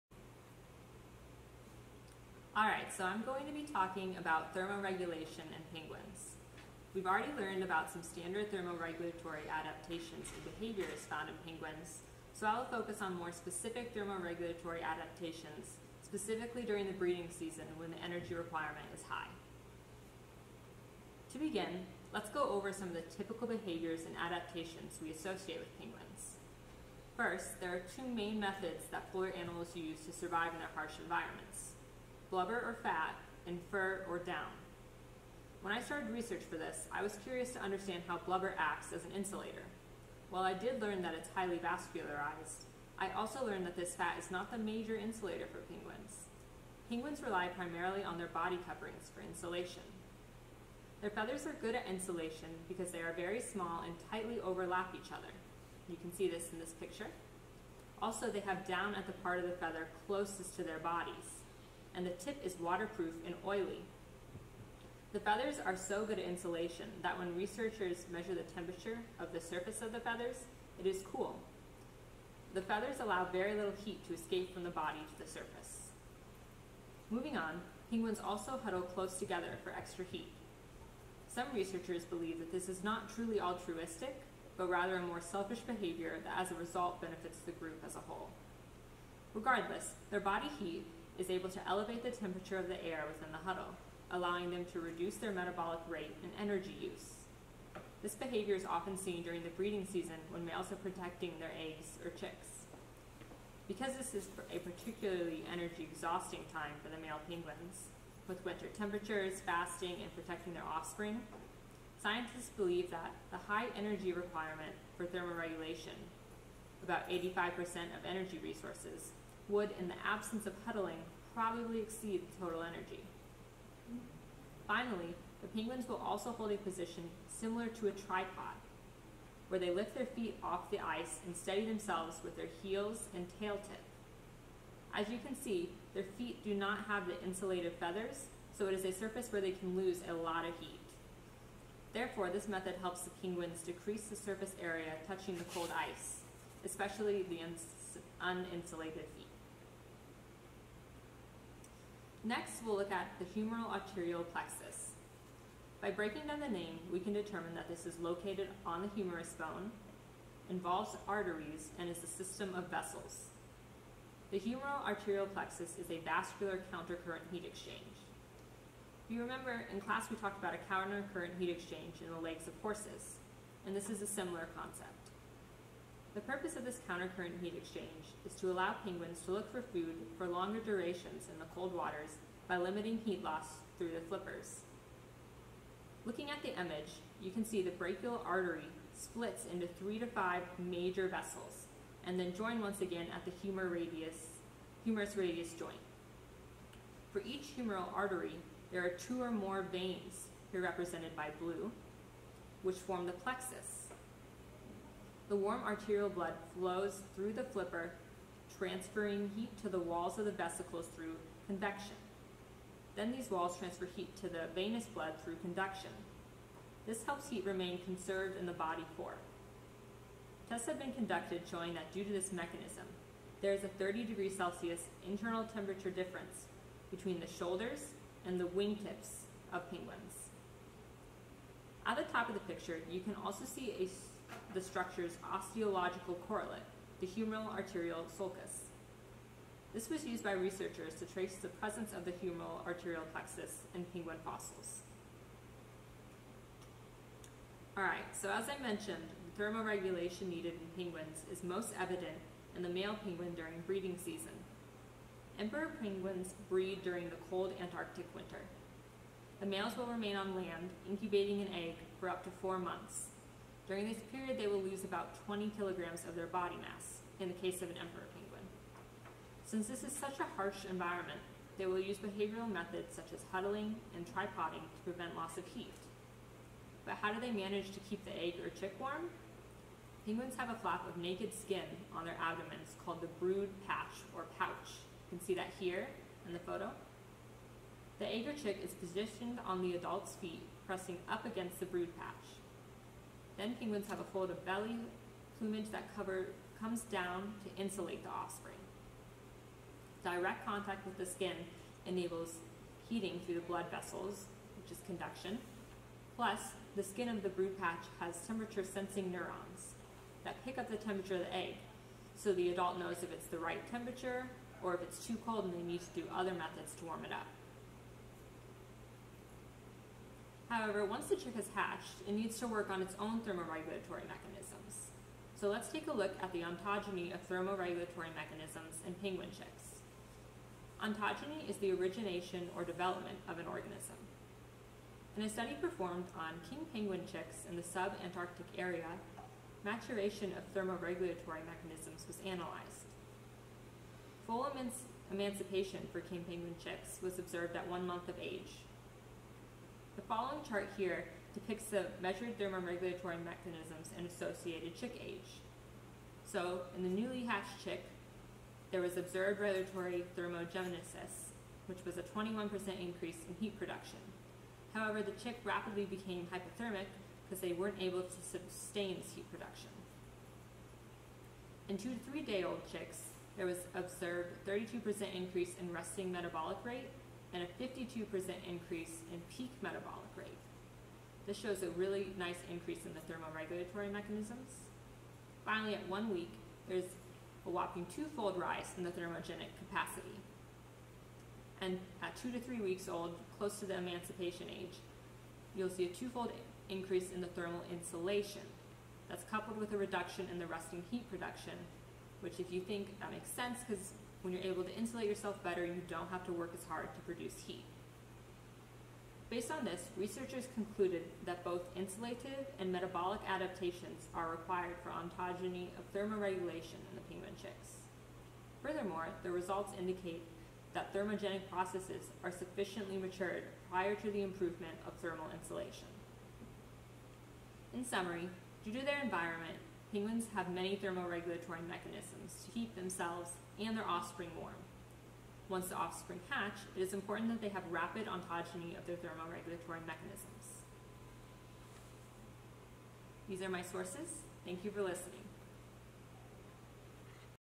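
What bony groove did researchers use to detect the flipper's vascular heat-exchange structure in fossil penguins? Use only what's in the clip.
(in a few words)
humeral arterial sulcus.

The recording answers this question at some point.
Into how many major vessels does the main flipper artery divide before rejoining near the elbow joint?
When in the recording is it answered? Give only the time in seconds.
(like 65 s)
189 s.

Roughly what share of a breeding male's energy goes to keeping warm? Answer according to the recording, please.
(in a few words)
85%.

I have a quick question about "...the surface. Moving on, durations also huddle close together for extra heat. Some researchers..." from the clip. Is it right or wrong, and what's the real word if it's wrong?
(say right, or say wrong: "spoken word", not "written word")
wrong: "penguins", not "durations".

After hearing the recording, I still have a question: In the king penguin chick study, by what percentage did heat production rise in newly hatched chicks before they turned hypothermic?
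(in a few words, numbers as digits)
21%.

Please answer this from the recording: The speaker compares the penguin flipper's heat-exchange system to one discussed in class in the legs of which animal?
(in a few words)
horses.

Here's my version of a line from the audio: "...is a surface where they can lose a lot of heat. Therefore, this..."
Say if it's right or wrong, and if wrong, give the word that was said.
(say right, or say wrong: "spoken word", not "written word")
right.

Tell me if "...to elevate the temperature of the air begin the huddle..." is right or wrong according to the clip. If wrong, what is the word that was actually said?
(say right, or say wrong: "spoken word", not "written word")
wrong: "within", not "begin".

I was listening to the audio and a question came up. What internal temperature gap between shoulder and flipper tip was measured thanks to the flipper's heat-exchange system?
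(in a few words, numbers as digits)
30 degrees Celsius.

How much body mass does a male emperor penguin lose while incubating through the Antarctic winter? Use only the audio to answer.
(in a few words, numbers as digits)
20 kilograms.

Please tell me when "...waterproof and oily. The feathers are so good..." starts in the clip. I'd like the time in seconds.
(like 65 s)
62 s.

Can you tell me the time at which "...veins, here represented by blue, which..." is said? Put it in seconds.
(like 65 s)
199 s.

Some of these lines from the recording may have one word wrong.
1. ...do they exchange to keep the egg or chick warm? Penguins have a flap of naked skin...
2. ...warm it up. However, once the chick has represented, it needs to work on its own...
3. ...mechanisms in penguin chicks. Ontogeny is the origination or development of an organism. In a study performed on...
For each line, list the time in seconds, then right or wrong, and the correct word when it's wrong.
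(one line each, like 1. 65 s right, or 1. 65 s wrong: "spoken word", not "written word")
1. 277 s wrong: "manage", not "exchange"
2. 316 s wrong: "hatched", not "represented"
3. 328 s right.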